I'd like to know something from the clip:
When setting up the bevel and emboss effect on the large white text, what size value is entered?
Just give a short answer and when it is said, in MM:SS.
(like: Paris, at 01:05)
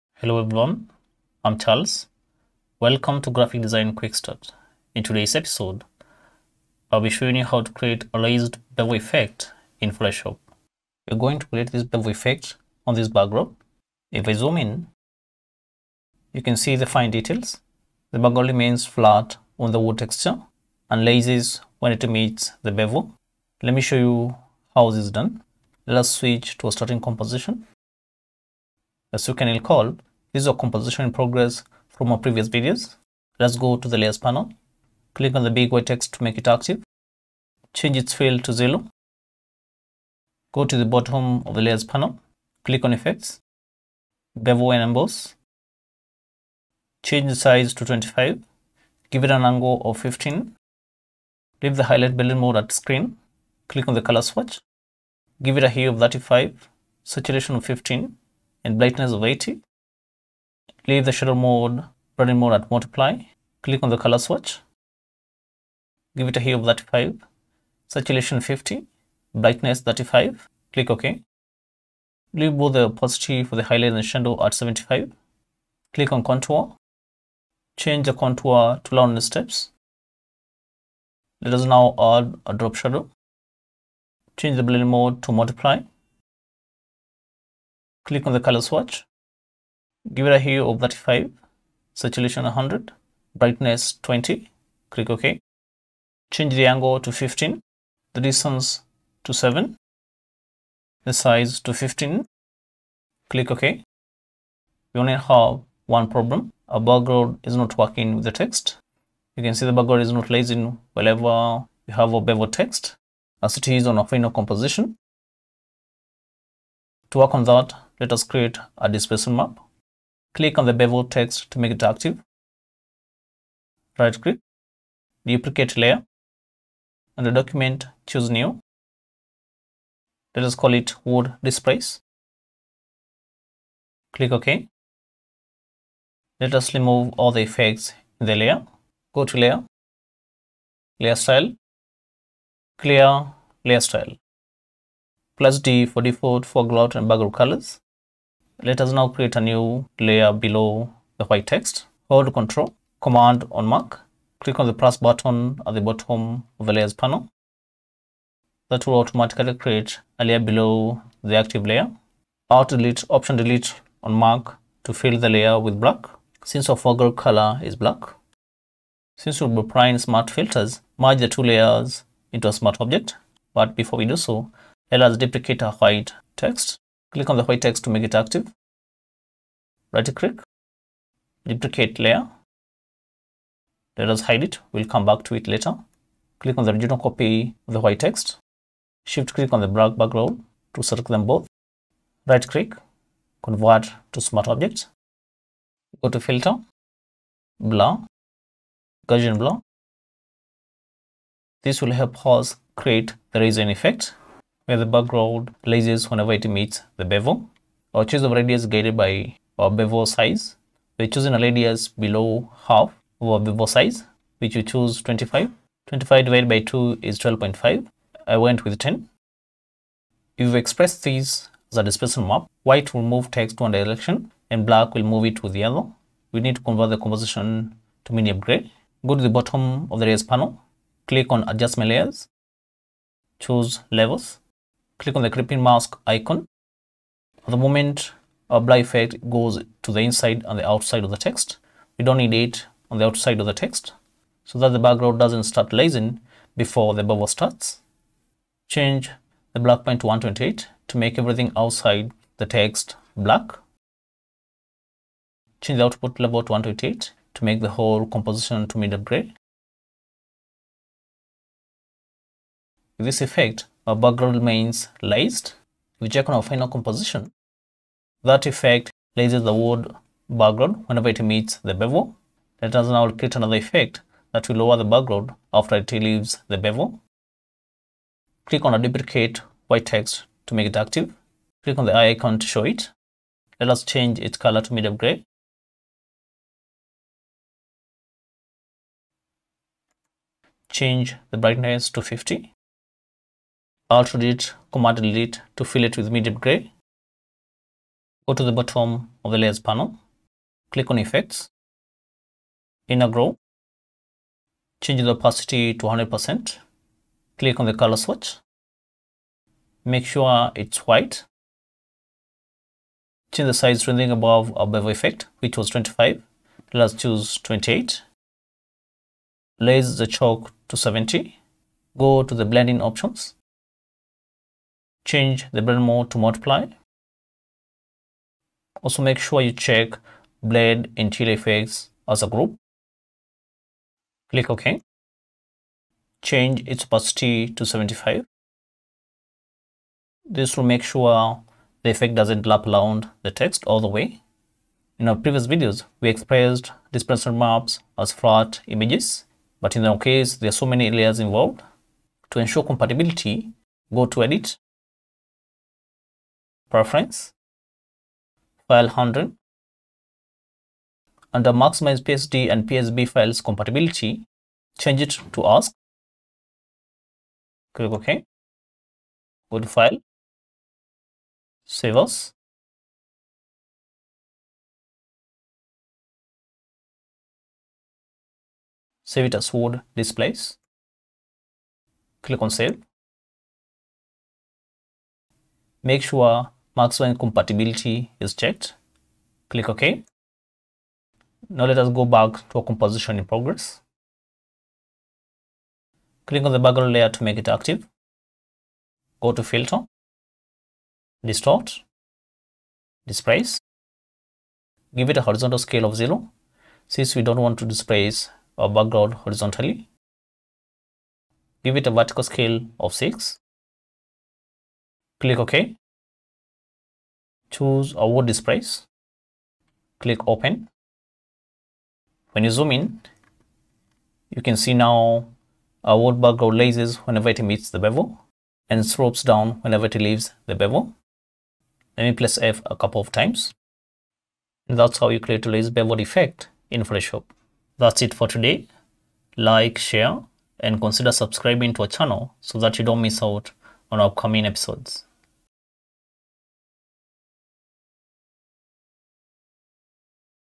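25, at 00:47.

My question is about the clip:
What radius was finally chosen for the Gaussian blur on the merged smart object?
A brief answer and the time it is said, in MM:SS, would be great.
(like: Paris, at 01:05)
10, at 03:38.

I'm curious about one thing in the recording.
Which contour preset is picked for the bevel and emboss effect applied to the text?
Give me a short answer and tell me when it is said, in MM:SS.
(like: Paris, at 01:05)
round steps, at 01:18.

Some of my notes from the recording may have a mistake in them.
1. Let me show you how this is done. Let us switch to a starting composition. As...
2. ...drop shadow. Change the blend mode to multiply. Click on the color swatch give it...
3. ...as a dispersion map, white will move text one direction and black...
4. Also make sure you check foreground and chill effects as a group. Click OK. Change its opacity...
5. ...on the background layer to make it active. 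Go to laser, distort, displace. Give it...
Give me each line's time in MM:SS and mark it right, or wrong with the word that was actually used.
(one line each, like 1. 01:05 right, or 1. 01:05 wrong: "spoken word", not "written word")
1. 00:23 right
2. 01:22 right
3. 03:41 right
4. 05:28 wrong: "blend", not "foreground"
5. 06:36 wrong: "filter", not "laser".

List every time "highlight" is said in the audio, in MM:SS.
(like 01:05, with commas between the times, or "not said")
00:51, 01:13.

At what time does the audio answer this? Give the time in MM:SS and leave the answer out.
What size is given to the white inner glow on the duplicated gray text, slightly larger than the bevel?
05:16.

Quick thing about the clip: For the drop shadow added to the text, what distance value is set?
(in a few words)
7.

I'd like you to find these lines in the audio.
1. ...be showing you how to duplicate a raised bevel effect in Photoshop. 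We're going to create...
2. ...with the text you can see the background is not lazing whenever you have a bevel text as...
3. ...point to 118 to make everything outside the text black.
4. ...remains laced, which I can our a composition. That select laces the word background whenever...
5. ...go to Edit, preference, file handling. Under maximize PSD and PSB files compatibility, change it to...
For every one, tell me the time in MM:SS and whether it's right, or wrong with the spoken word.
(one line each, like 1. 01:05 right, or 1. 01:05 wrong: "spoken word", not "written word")
1. 00:07 wrong: "create", not "duplicate"
2. 01:48 right
3. 04:09 wrong: "128", not "118"
4. 04:24 wrong: "effect", not "select"
5. 05:53 right.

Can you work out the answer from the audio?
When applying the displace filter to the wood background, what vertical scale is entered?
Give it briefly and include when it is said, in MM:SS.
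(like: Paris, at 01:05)
6, at 06:51.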